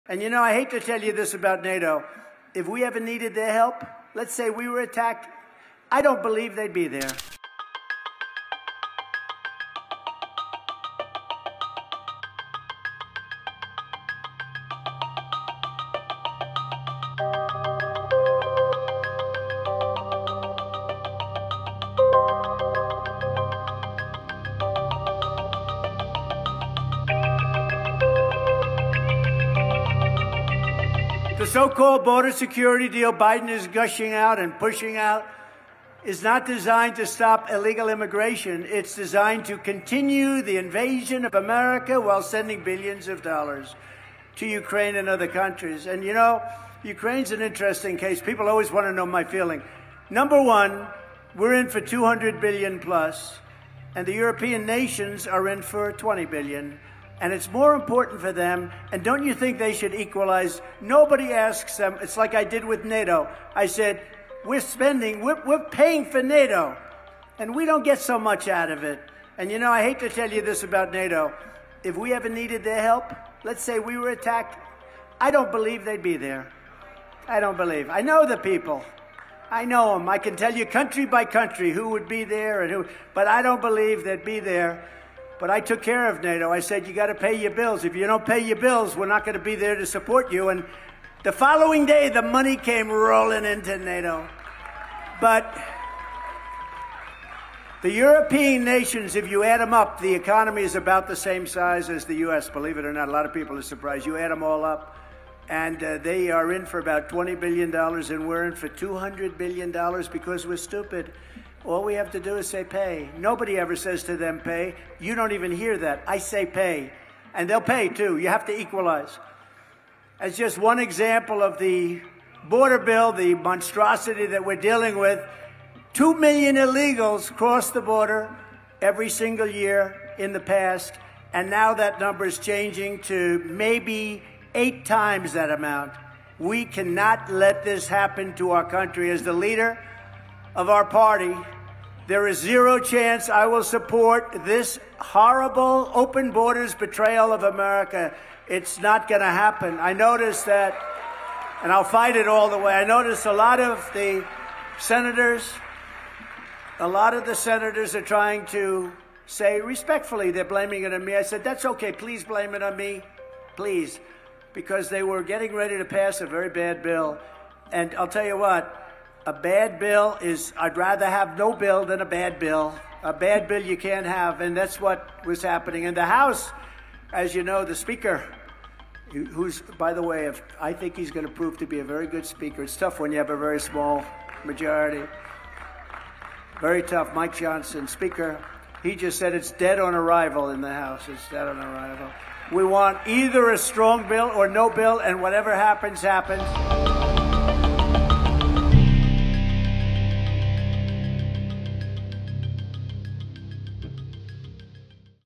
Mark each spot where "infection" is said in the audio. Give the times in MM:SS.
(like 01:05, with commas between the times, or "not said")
not said.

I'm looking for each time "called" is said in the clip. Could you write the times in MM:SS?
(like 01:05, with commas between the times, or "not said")
00:31.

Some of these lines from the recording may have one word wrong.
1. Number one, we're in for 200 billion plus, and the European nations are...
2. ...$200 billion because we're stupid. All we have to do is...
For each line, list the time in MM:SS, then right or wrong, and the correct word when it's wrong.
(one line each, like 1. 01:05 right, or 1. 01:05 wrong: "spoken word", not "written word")
1. 00:50 right
2. 01:48 right.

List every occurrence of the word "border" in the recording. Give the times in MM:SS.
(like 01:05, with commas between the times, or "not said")
00:32, 02:02, 02:07, 02:26.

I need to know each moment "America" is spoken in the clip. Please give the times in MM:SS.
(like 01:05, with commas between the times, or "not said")
00:41, 02:27.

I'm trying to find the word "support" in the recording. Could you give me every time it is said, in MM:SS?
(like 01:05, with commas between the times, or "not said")
01:29, 02:23.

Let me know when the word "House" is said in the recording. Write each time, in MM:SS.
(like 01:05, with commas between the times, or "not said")
02:56, 03:10.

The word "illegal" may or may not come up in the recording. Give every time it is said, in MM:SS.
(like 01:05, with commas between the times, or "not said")
00:37, 02:06.